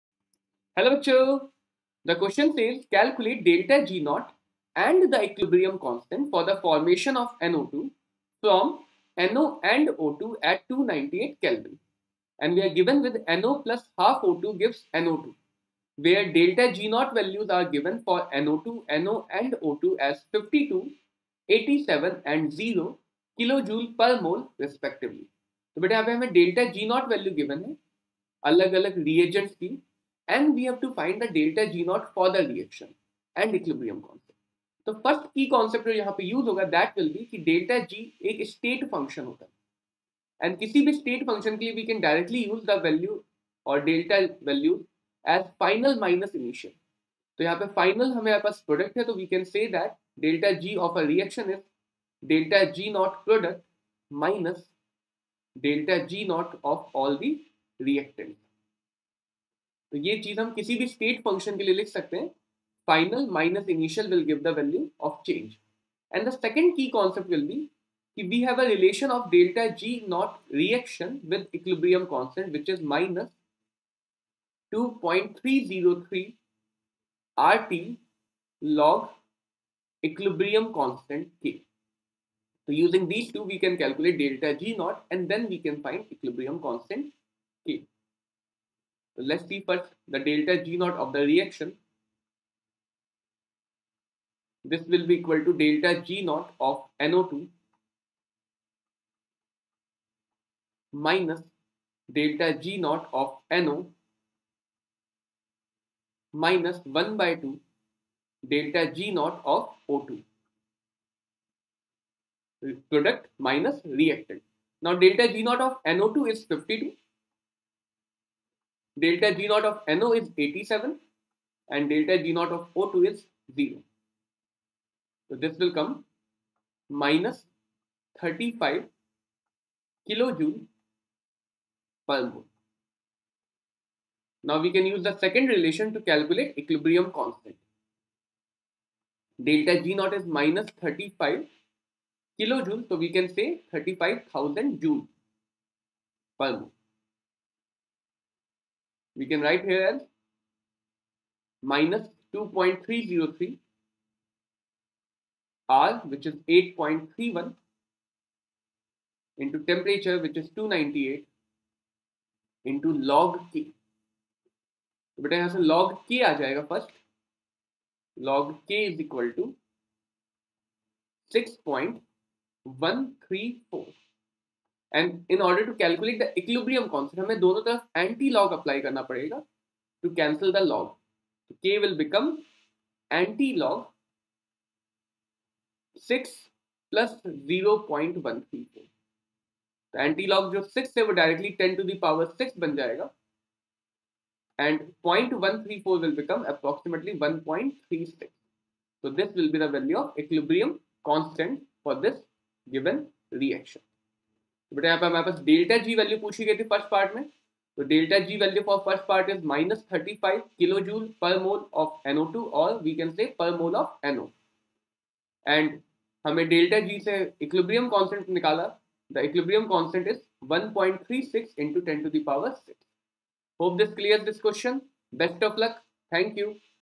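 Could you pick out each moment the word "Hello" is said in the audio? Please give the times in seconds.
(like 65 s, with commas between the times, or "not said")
0 s.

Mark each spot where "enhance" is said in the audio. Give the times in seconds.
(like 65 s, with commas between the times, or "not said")
not said.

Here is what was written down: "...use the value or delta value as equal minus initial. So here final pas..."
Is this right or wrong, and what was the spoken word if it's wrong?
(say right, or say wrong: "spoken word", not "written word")
wrong: "final", not "equal".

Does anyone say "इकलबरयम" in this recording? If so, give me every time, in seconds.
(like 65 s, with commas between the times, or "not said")
176 s, 200 s.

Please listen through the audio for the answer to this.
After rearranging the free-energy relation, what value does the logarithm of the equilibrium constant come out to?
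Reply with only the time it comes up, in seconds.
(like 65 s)
171 s.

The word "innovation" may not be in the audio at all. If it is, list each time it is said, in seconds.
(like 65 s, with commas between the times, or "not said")
not said.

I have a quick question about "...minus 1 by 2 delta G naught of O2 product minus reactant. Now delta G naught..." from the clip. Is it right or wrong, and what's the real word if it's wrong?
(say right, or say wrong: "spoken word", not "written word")
right.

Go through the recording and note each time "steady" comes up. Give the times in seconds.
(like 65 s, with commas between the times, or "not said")
not said.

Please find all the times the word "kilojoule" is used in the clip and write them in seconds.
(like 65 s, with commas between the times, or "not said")
23 s, 130 s, 142 s.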